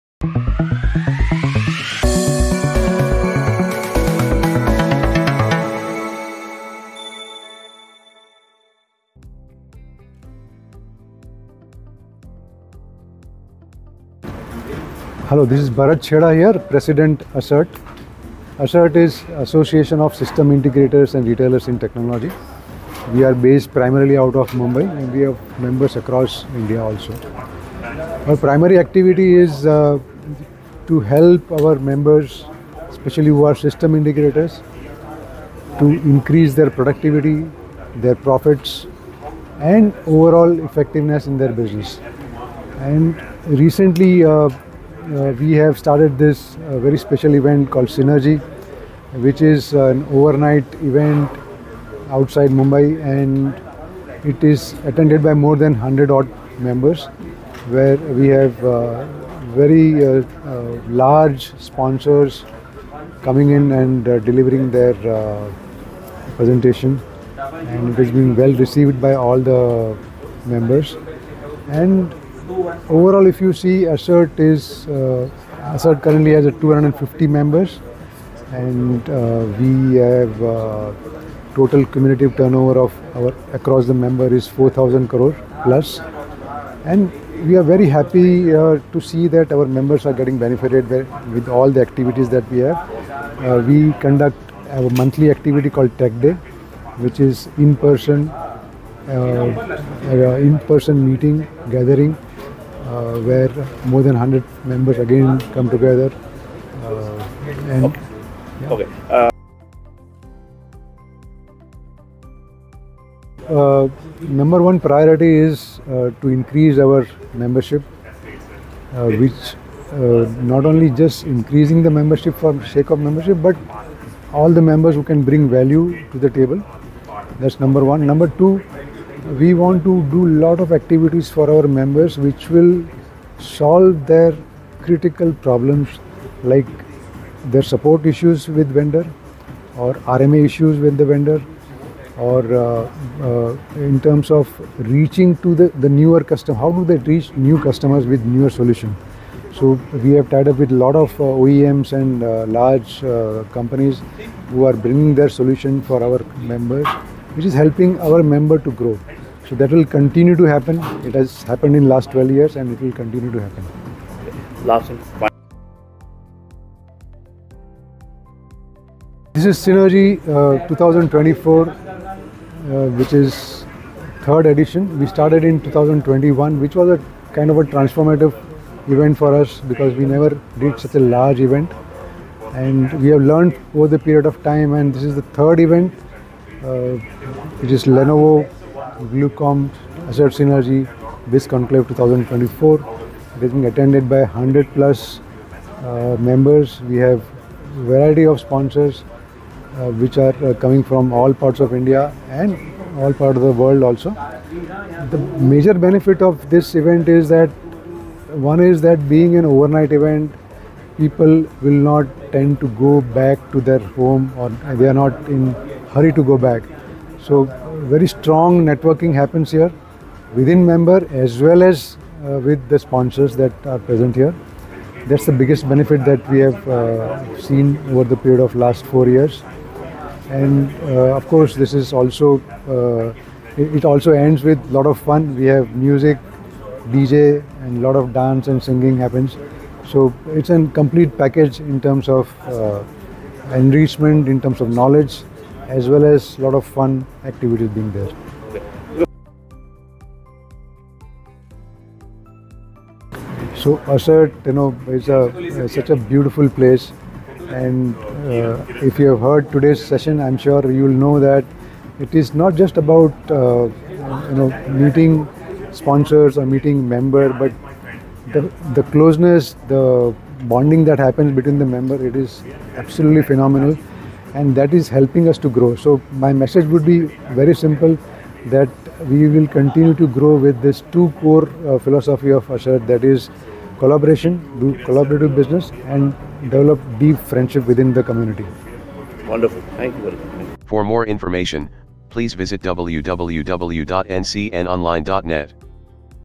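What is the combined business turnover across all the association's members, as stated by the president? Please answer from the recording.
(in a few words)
4,000 crore plus.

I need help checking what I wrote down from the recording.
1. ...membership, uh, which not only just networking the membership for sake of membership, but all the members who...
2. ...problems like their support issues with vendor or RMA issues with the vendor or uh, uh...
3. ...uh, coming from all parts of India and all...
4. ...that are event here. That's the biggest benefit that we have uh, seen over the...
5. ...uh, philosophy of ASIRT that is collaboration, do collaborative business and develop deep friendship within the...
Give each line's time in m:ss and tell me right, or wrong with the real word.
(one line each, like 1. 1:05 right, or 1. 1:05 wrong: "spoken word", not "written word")
1. 1:57 wrong: "increasing", not "networking"
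2. 2:15 right
3. 3:20 right
4. 3:43 wrong: "present", not "event"
5. 4:41 right.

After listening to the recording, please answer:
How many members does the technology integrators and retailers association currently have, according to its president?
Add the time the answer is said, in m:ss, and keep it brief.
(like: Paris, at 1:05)
250, at 1:16.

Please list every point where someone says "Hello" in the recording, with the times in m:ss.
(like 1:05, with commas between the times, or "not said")
0:15.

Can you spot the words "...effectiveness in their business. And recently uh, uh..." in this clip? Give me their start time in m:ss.
0:40.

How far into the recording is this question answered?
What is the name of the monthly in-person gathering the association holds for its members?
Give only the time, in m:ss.
1:35.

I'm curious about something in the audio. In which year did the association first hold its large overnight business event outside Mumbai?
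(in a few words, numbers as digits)
2021.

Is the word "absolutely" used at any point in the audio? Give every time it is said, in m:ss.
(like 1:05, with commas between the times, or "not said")
4:32.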